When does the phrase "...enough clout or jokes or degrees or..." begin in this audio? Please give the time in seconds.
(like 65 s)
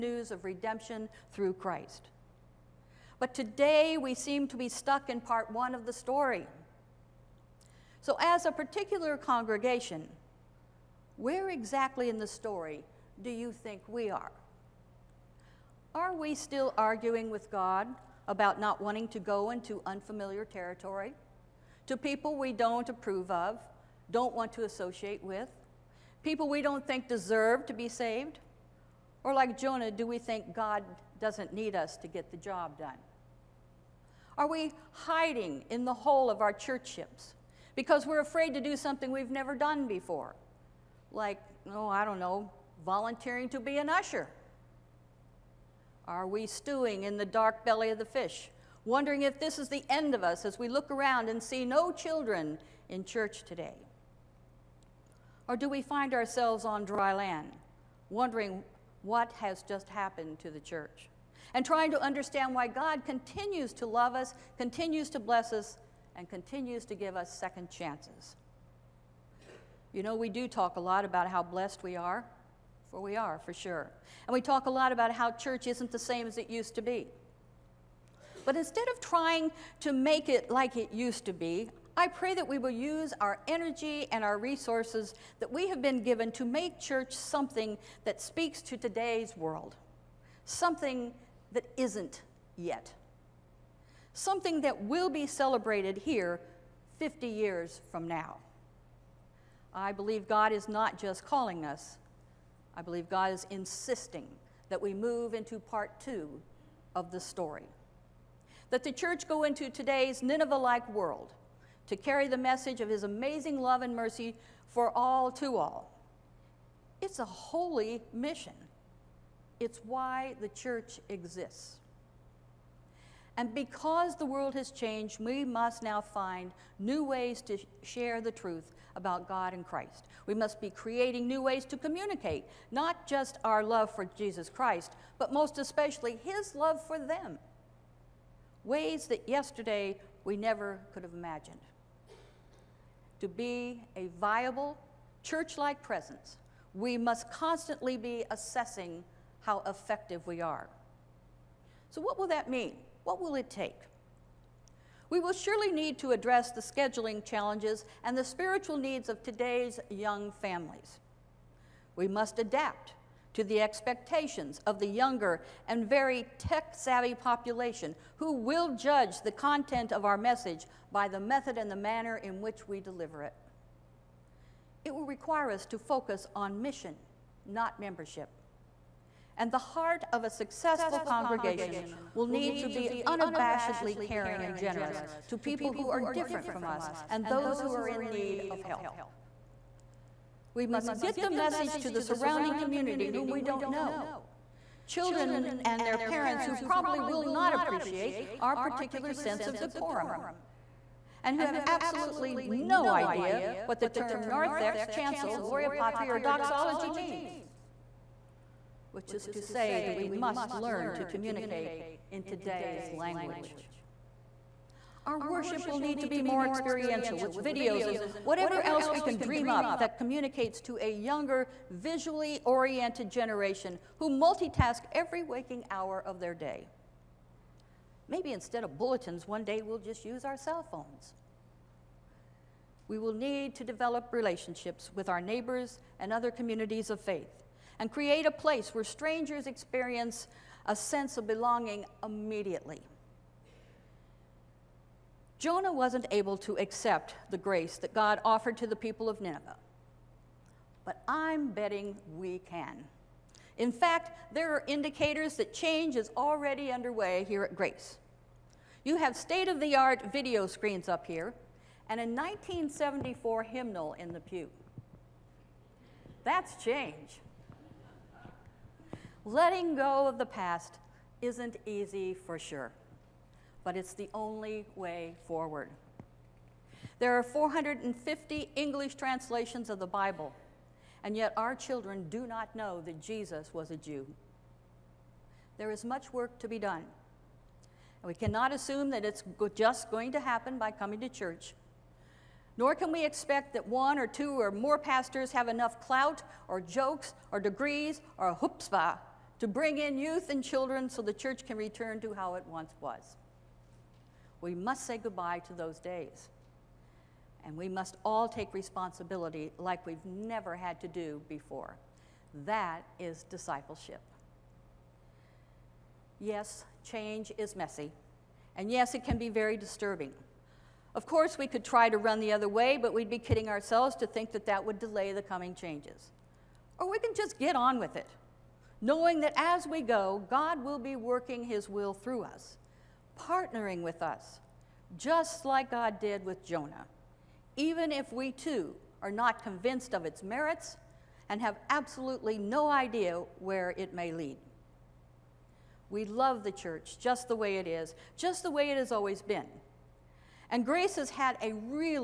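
295 s.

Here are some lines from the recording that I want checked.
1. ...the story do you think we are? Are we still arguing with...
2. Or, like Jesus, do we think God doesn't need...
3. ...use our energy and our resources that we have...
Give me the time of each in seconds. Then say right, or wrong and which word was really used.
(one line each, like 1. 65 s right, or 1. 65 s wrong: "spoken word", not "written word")
1. 12 s right
2. 29 s wrong: "Jonah", not "Jesus"
3. 82 s right.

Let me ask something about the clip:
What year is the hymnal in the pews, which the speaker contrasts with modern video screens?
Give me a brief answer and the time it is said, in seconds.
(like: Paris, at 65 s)
1974, at 262 s.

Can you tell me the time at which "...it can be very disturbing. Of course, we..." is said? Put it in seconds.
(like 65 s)
318 s.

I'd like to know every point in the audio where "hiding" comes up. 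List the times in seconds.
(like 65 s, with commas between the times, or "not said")
34 s.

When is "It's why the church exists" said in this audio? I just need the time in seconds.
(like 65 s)
119 s.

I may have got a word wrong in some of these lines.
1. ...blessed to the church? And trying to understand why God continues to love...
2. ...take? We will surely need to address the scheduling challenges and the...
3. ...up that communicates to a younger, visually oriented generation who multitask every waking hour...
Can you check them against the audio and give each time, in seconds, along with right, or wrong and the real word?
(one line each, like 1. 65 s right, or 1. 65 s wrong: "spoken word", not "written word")
1. 59 s wrong: "happened", not "blessed"
2. 153 s right
3. 219 s right.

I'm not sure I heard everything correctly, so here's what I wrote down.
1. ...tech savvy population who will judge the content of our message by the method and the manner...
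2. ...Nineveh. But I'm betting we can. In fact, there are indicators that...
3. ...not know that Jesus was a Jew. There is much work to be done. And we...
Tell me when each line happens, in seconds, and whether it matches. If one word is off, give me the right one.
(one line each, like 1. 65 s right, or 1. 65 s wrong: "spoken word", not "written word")
1. 166 s right
2. 249 s right
3. 282 s right.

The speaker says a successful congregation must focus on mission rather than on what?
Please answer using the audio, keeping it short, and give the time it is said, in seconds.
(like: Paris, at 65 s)
membership, at 177 s.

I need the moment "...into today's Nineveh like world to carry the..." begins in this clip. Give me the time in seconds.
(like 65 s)
109 s.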